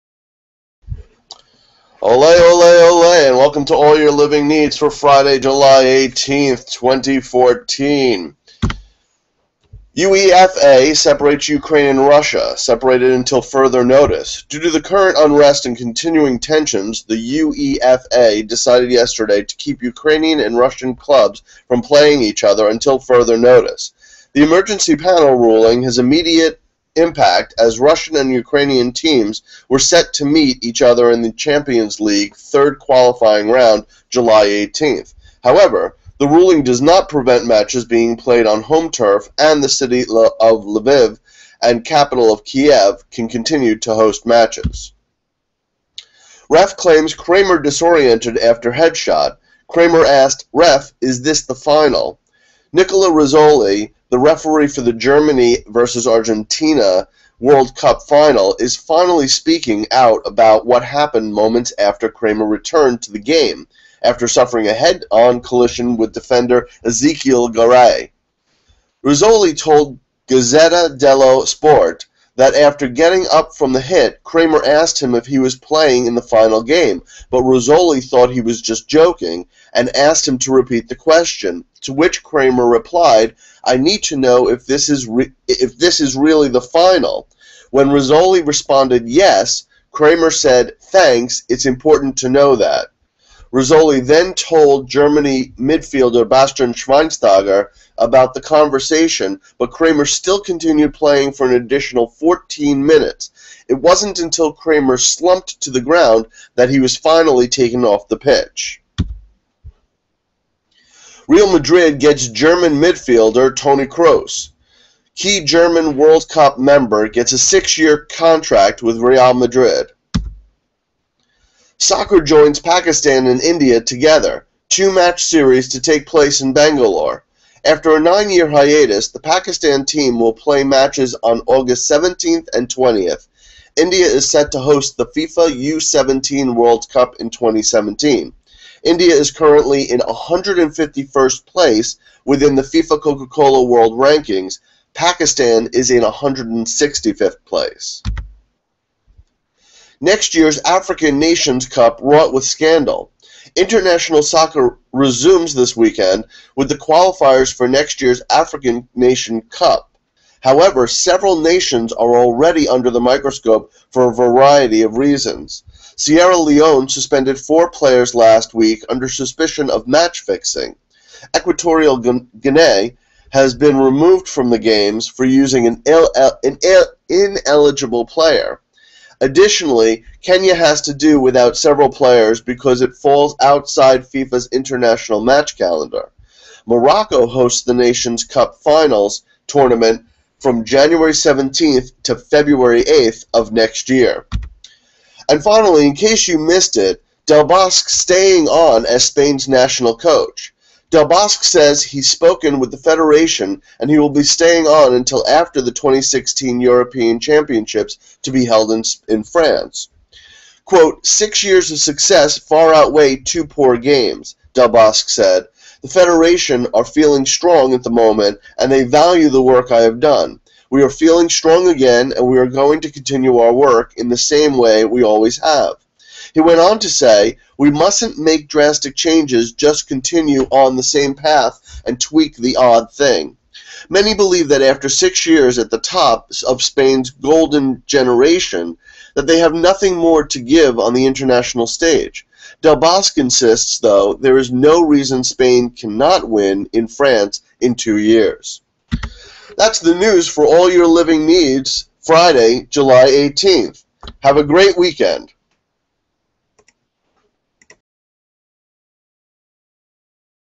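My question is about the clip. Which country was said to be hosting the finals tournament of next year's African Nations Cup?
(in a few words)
Morocco.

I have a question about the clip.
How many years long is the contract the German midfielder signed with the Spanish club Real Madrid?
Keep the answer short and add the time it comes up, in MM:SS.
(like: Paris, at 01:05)
6, at 01:57.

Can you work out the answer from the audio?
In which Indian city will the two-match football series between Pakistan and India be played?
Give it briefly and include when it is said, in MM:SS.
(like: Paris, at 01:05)
Bangalore, at 02:06.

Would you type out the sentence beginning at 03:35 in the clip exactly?
The Federation are feeling strong at the moment and they value the work I have done.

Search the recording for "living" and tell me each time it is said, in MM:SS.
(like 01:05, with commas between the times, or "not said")
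00:04, 04:10.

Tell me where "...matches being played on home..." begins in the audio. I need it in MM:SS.
00:37.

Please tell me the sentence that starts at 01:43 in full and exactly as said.
It wasn't until Kramer slumped to the ground that he was finally taken off the pitch.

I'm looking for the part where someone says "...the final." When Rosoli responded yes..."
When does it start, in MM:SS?
01:26.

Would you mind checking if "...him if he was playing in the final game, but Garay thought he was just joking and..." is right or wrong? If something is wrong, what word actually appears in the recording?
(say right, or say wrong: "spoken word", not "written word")
wrong: "Rosoli", not "Garay".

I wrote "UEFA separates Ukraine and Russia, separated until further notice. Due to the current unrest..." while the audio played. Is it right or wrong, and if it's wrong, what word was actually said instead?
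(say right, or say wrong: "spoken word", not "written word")
right.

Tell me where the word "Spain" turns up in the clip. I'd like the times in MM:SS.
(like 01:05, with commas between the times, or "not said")
03:19, 03:56, 04:05.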